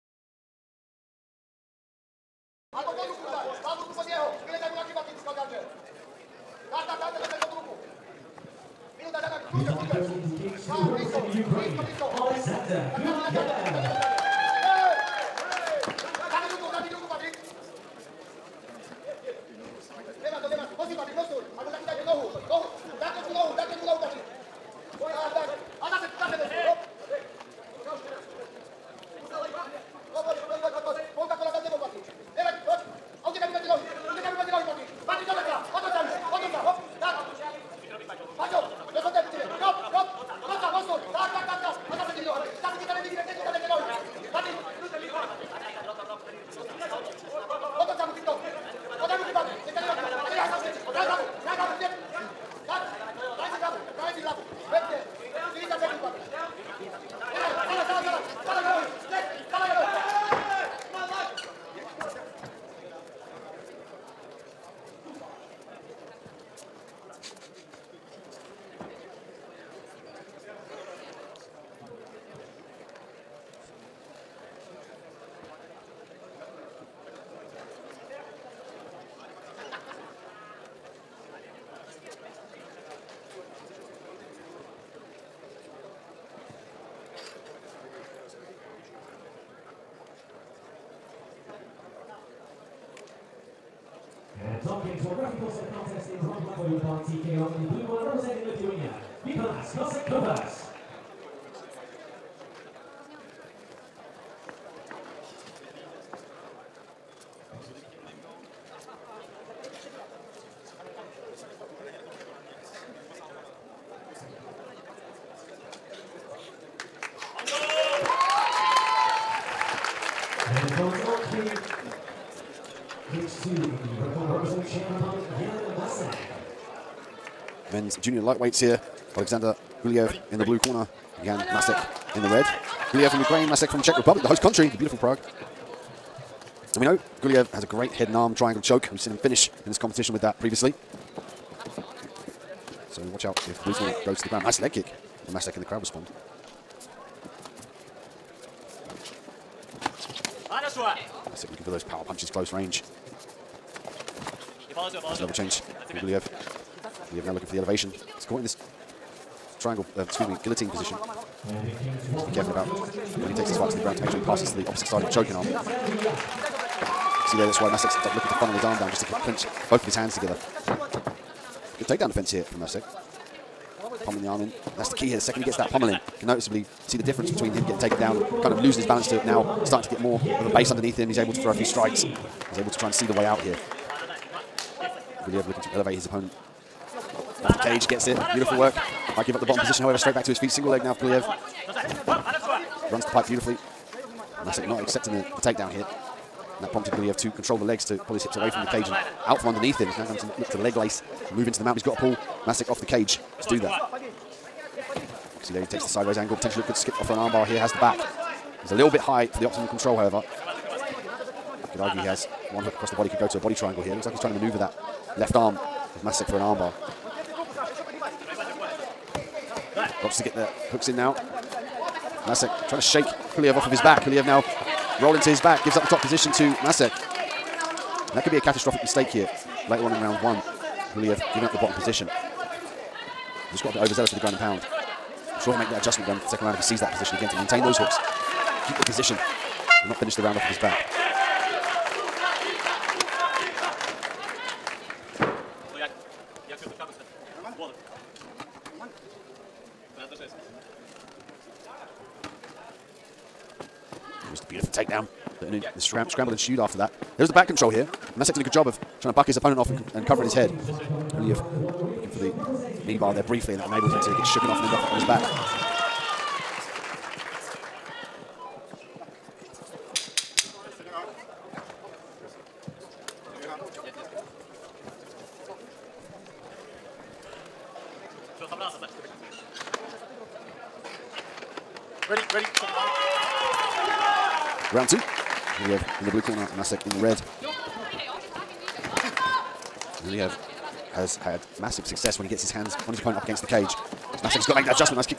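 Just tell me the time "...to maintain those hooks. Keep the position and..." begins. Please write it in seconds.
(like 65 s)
237 s.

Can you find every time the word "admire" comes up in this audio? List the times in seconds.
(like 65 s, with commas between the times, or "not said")
not said.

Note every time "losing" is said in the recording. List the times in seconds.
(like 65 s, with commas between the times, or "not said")
178 s.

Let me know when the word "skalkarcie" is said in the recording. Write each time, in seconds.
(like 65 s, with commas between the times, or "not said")
5 s.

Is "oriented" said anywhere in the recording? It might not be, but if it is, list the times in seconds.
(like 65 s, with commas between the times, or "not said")
not said.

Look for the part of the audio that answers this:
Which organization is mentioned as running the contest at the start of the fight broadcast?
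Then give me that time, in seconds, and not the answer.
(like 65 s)
97 s.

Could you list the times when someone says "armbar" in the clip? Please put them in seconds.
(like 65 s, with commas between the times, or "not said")
207 s, 216 s.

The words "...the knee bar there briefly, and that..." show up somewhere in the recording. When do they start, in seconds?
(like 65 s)
262 s.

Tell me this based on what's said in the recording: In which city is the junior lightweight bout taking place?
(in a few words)
Prague.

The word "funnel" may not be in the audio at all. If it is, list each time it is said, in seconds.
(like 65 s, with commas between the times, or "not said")
168 s.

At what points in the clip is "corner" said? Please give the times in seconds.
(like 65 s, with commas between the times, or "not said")
130 s, 286 s.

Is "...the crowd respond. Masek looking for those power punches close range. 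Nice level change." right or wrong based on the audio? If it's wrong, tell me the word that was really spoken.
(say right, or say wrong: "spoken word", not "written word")
right.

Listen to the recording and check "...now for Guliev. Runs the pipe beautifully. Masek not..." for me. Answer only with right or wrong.
right.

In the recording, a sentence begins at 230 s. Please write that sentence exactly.
Guliev giving up the bottom position.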